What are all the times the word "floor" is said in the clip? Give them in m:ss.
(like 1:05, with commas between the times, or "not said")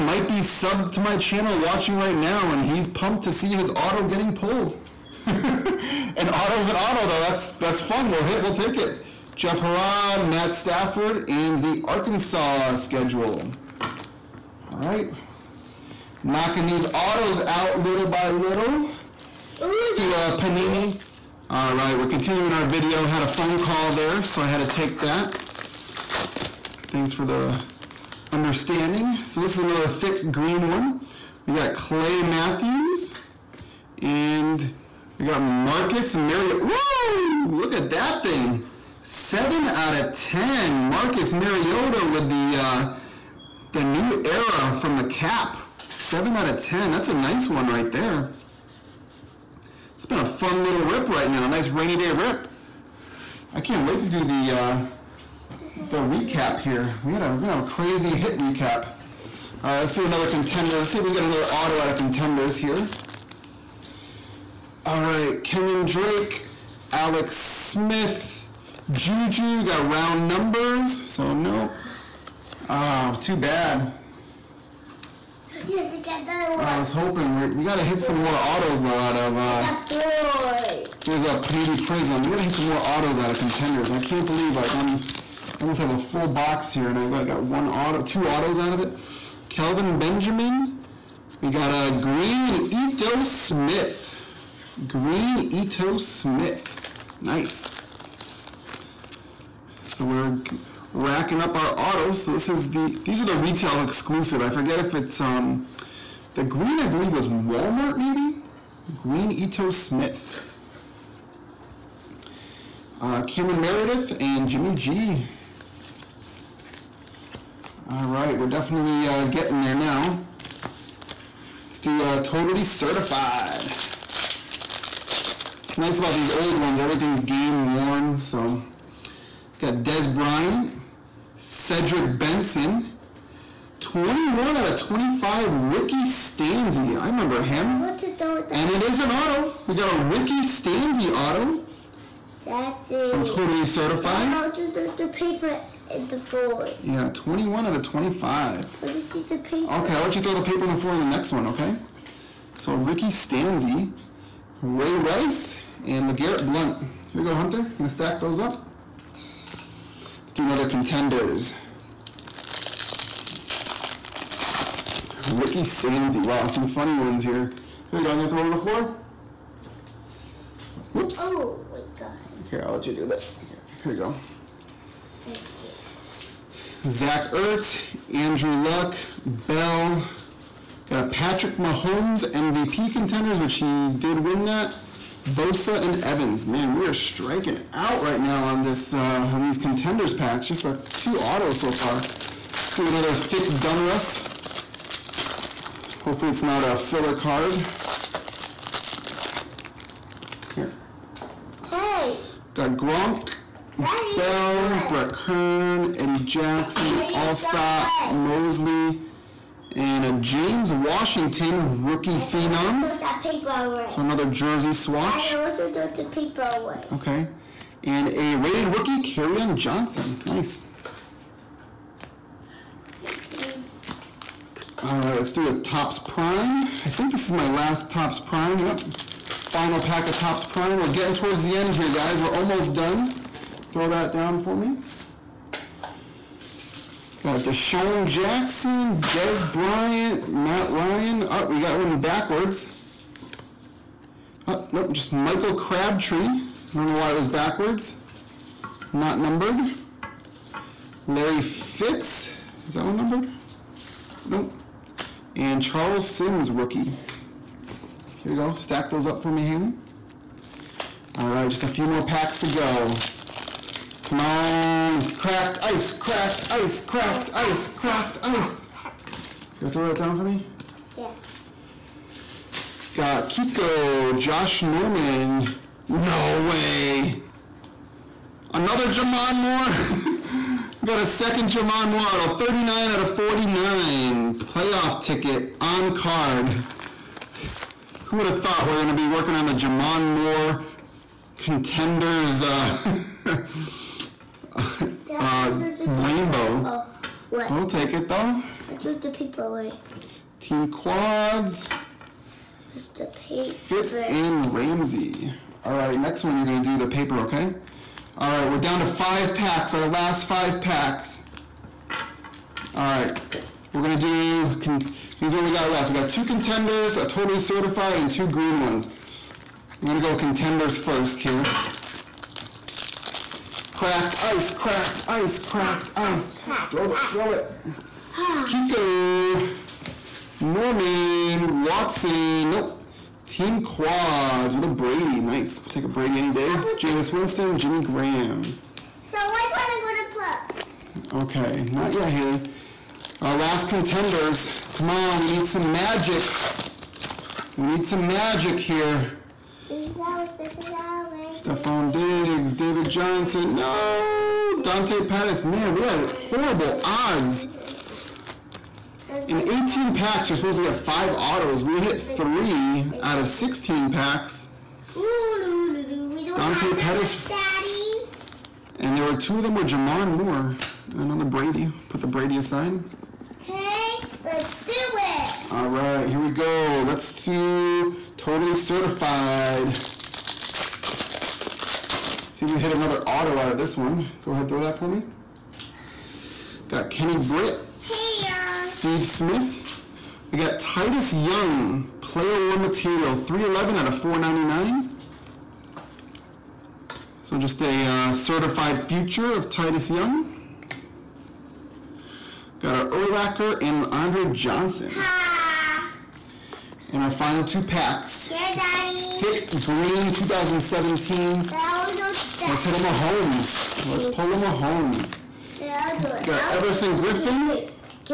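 2:26, 2:30, 2:48.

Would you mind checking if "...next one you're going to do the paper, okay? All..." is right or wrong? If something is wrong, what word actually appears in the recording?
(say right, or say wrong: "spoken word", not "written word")
right.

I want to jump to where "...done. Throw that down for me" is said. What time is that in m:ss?
3:52.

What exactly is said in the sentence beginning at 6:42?
Got our Urlacher and Andre Johnson.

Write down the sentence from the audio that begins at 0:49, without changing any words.
It's been a fun little rip right now.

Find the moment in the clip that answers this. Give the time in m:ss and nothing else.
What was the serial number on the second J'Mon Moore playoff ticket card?
4:42.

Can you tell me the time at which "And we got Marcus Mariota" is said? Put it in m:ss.
0:34.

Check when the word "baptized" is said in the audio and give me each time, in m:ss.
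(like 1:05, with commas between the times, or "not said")
not said.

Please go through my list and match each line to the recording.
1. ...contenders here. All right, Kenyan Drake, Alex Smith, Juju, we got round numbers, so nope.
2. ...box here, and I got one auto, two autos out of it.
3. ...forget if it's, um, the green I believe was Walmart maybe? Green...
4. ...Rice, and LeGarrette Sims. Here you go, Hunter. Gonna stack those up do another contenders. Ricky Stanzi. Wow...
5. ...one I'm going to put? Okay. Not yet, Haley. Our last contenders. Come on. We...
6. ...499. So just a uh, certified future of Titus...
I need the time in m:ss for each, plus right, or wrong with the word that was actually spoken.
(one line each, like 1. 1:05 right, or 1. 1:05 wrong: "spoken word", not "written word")
1. 1:01 right
2. 1:26 right
3. 1:44 right
4. 2:34 wrong: "Blount", not "Sims"
5. 5:39 right
6. 6:33 right.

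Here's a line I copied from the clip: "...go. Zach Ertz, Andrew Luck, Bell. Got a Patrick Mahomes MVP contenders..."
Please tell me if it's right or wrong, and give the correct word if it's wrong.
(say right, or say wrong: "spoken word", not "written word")
right.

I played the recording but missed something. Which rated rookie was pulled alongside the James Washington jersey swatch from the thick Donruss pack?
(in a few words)
Carrion Johnson.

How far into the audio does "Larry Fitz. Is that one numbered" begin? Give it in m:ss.
4:11.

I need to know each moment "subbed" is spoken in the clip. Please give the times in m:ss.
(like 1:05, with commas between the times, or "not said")
0:00.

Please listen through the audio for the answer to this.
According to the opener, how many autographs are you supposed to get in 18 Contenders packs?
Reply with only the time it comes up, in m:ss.
6:00.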